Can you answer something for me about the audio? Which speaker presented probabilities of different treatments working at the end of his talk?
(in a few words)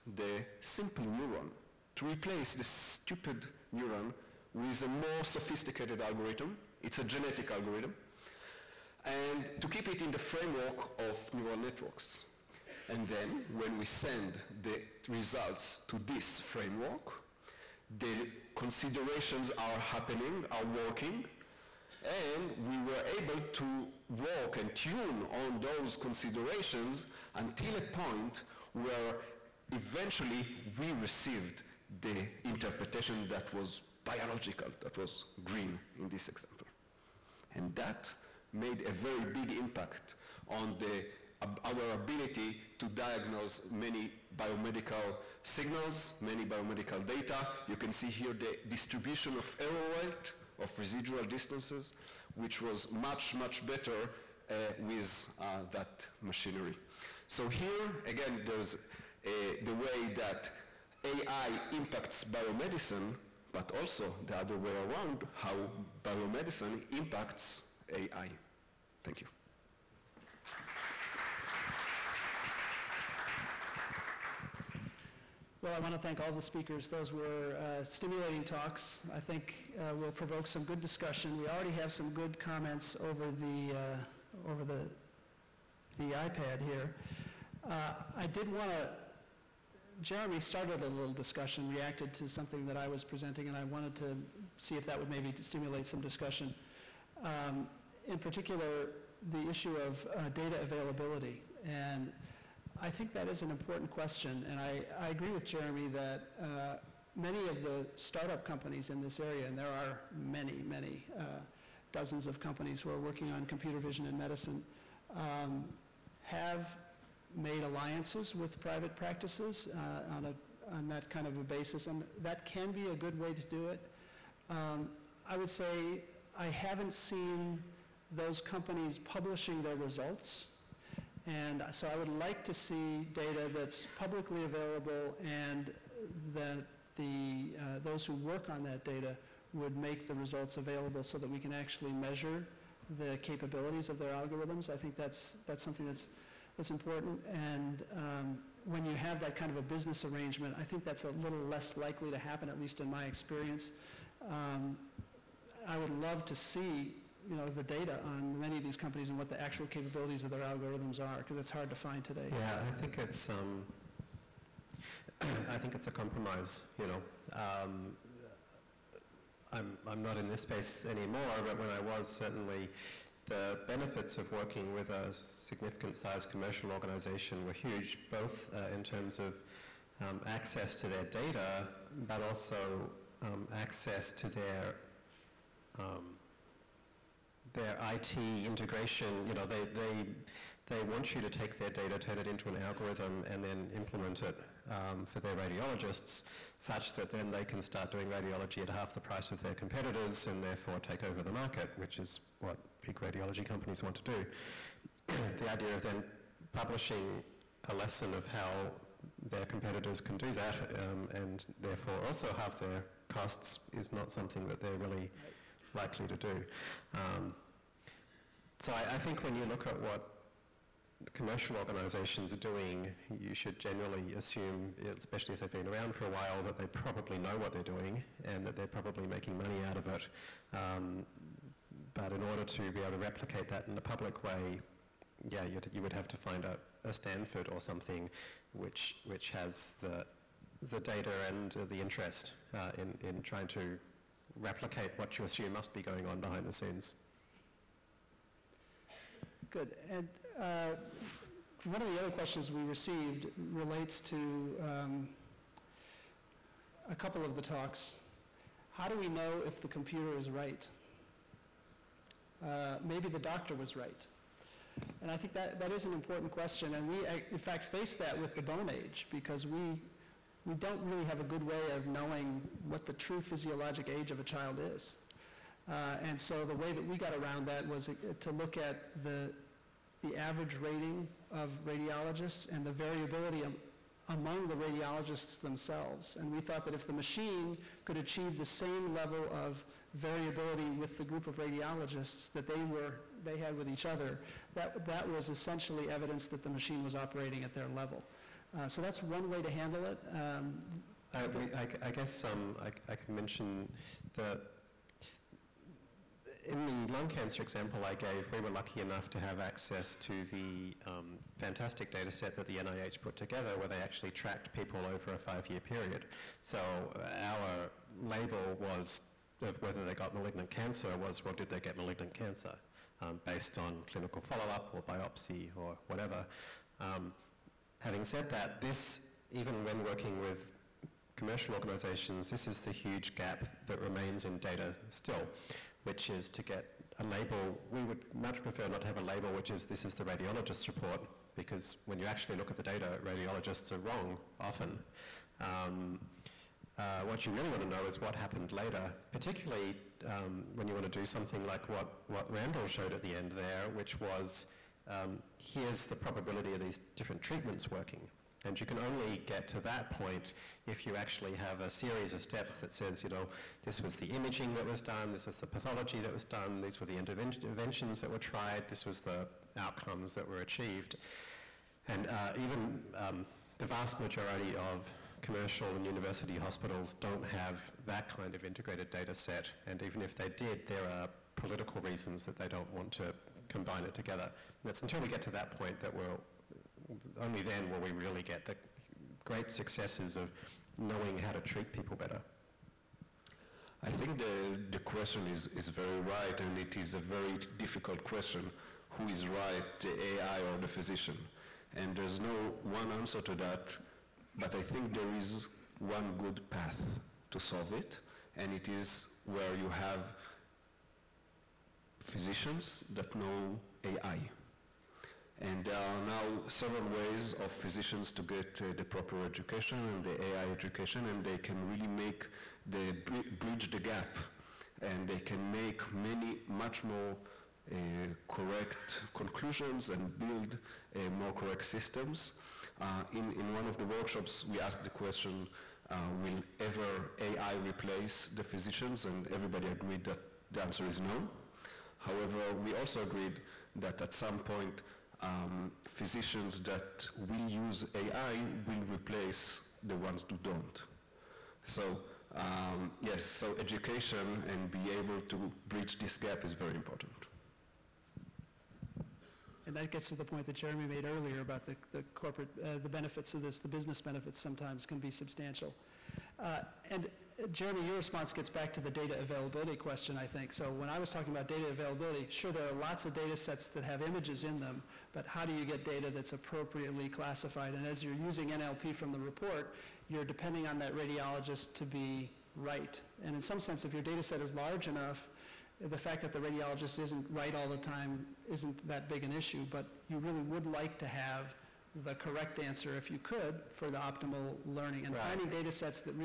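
Randall.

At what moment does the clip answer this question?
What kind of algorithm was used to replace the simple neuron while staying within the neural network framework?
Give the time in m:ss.
0:07.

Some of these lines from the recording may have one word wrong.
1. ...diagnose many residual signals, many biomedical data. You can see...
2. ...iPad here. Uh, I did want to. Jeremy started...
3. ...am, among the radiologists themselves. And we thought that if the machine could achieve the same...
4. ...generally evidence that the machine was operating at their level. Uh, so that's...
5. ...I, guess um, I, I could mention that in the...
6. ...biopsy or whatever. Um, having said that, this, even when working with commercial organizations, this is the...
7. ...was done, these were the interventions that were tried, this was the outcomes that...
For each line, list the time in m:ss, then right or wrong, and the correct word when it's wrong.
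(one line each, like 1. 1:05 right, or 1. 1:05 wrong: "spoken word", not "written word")
1. 0:42 wrong: "biomedical", not "residual"
2. 1:26 right
3. 4:43 right
4. 4:55 wrong: "essentially", not "generally"
5. 5:01 right
6. 5:24 right
7. 6:06 right.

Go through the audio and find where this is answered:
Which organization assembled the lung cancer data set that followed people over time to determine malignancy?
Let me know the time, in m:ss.
5:12.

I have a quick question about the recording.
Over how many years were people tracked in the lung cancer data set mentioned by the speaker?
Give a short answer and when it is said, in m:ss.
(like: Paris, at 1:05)
5, at 5:15.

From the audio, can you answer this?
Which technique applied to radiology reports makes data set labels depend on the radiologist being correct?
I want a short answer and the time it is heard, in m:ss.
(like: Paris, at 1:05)
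NLP, at 7:58.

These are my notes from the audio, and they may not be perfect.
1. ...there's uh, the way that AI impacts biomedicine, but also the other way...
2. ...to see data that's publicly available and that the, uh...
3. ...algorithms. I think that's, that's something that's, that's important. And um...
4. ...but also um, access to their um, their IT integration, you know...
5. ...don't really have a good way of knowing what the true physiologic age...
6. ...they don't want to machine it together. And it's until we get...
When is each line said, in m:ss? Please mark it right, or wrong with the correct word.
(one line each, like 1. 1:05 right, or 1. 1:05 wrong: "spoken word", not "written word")
1. 0:58 right
2. 2:12 right
3. 2:24 right
4. 3:02 right
5. 4:30 right
6. 6:22 wrong: "combine", not "machine".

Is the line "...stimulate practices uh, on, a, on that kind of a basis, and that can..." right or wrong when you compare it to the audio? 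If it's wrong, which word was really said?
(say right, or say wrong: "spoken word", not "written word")
wrong: "private", not "stimulate".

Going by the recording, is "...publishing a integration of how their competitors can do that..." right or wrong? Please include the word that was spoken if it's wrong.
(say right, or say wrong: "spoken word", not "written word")
wrong: "lesson", not "integration".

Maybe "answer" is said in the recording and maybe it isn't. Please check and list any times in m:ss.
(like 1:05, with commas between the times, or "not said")
6:42, 7:20, 8:12.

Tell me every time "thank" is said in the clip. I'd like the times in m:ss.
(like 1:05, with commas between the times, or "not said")
1:09, 1:15.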